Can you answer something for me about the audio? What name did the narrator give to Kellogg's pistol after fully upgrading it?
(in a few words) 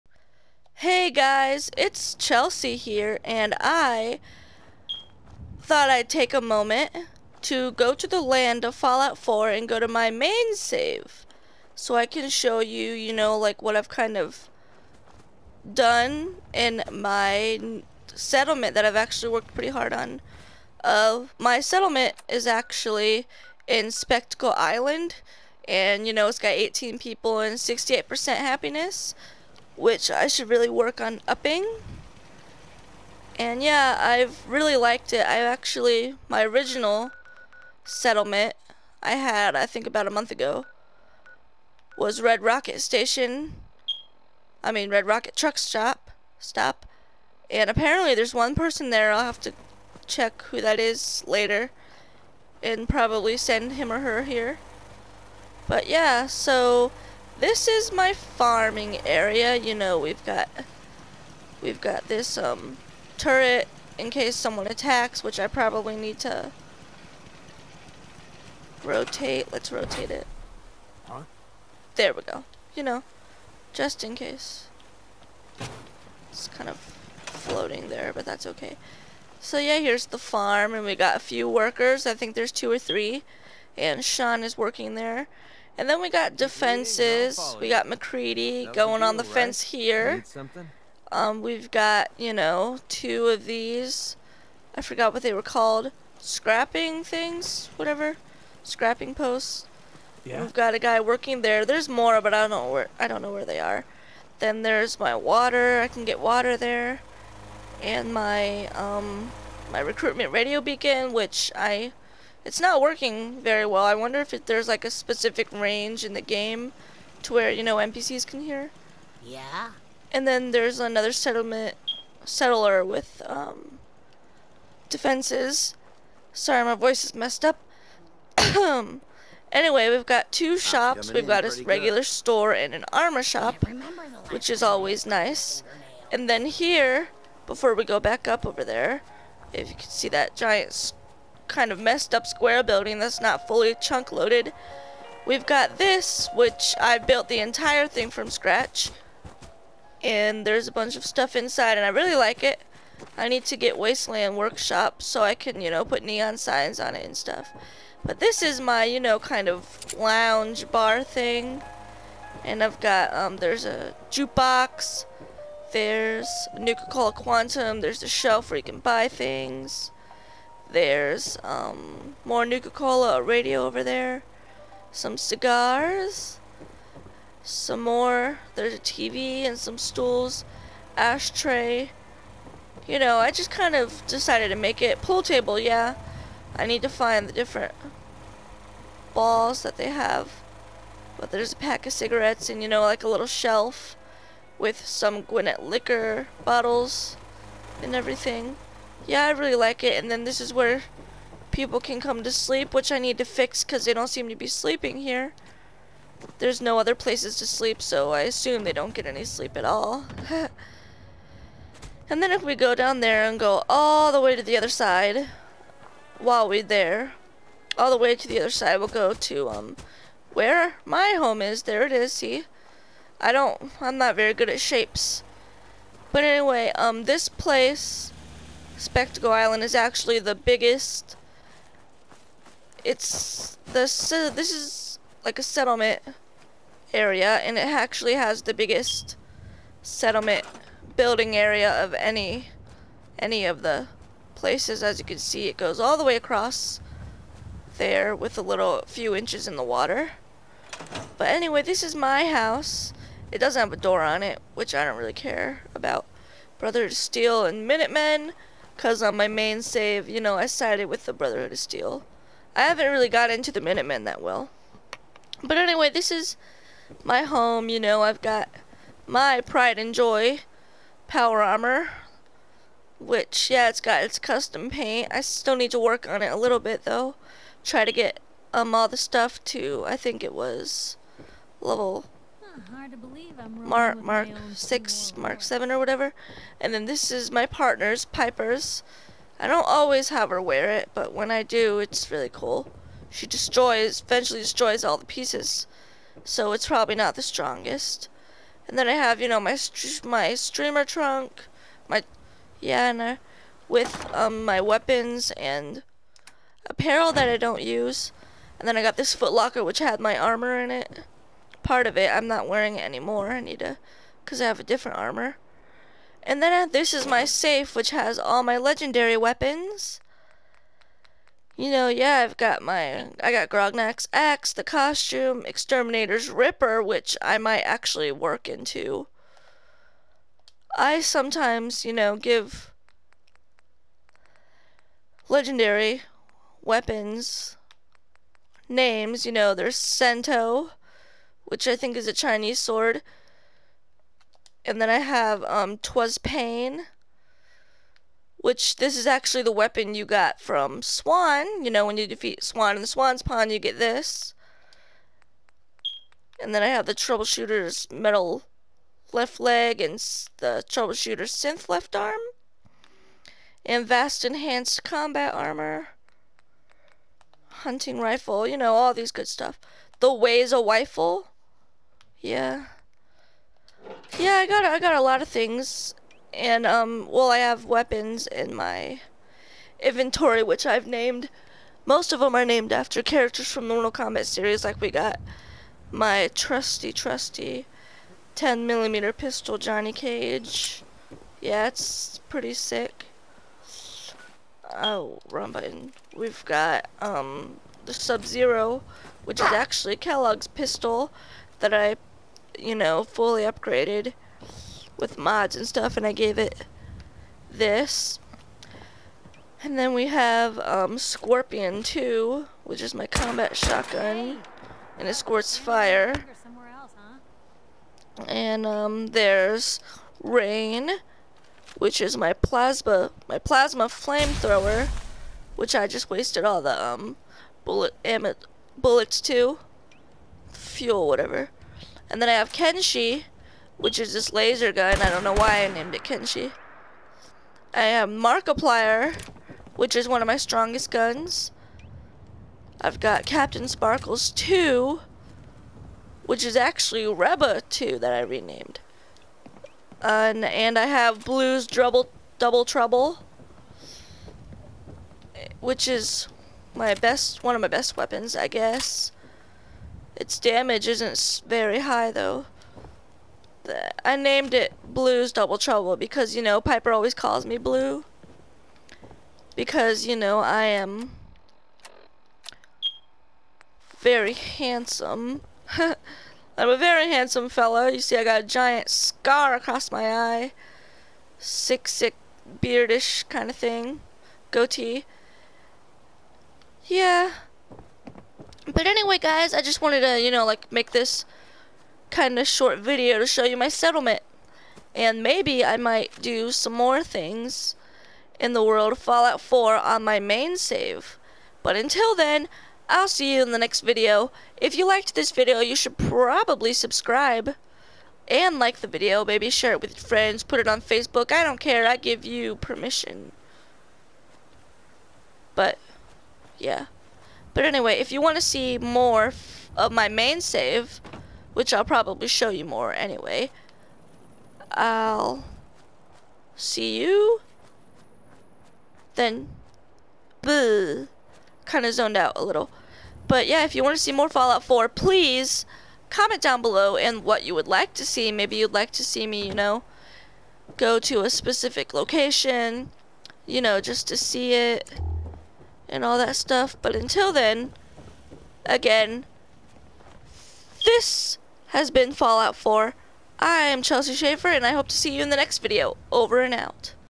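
Sub Zero.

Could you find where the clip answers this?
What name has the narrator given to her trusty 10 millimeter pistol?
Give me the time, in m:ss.
6:29.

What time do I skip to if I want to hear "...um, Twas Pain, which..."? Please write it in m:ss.
5:45.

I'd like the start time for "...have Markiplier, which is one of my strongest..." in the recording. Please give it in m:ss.
7:17.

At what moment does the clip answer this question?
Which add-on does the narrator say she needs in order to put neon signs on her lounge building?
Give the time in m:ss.
2:33.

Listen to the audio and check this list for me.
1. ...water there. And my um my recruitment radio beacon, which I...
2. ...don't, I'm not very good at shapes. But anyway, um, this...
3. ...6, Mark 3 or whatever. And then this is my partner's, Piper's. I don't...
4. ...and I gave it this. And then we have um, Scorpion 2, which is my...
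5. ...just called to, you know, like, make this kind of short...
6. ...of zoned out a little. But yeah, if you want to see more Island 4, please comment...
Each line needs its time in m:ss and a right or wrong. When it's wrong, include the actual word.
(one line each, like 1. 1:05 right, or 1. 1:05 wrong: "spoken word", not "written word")
1. 1:46 right
2. 3:43 right
3. 4:44 wrong: "7", not "3"
4. 6:45 right
5. 8:09 wrong: "wanted", not "called"
6. 8:51 wrong: "Fallout", not "Island".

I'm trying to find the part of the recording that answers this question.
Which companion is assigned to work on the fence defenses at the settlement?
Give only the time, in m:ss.
1:27.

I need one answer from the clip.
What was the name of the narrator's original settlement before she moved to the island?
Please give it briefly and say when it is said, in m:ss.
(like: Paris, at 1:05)
Red Rocket Truck Stop, at 0:44.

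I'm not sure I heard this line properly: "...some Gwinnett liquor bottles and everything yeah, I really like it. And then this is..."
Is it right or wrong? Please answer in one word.
right.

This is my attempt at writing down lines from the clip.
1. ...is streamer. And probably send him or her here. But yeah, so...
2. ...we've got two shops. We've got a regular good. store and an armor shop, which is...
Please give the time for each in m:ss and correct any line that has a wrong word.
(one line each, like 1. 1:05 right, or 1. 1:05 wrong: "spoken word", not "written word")
1. 0:50 wrong: "later", not "streamer"
2. 2:09 right.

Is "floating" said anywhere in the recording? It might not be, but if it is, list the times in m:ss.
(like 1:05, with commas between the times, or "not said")
1:17.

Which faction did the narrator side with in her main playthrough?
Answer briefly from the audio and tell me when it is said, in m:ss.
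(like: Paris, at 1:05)
Brotherhood of Steel, at 4:21.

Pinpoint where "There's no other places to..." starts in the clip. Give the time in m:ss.
3:26.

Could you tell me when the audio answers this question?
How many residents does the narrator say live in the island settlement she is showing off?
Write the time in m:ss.
0:26.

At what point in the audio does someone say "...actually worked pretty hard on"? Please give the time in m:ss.
0:18.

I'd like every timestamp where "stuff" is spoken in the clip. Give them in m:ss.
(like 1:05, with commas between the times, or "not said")
2:31, 2:37, 4:38, 6:09, 6:45, 9:06.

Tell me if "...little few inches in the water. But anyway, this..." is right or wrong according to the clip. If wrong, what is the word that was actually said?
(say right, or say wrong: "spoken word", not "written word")
right.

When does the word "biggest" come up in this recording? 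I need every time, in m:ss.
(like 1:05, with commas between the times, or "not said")
3:50, 3:58.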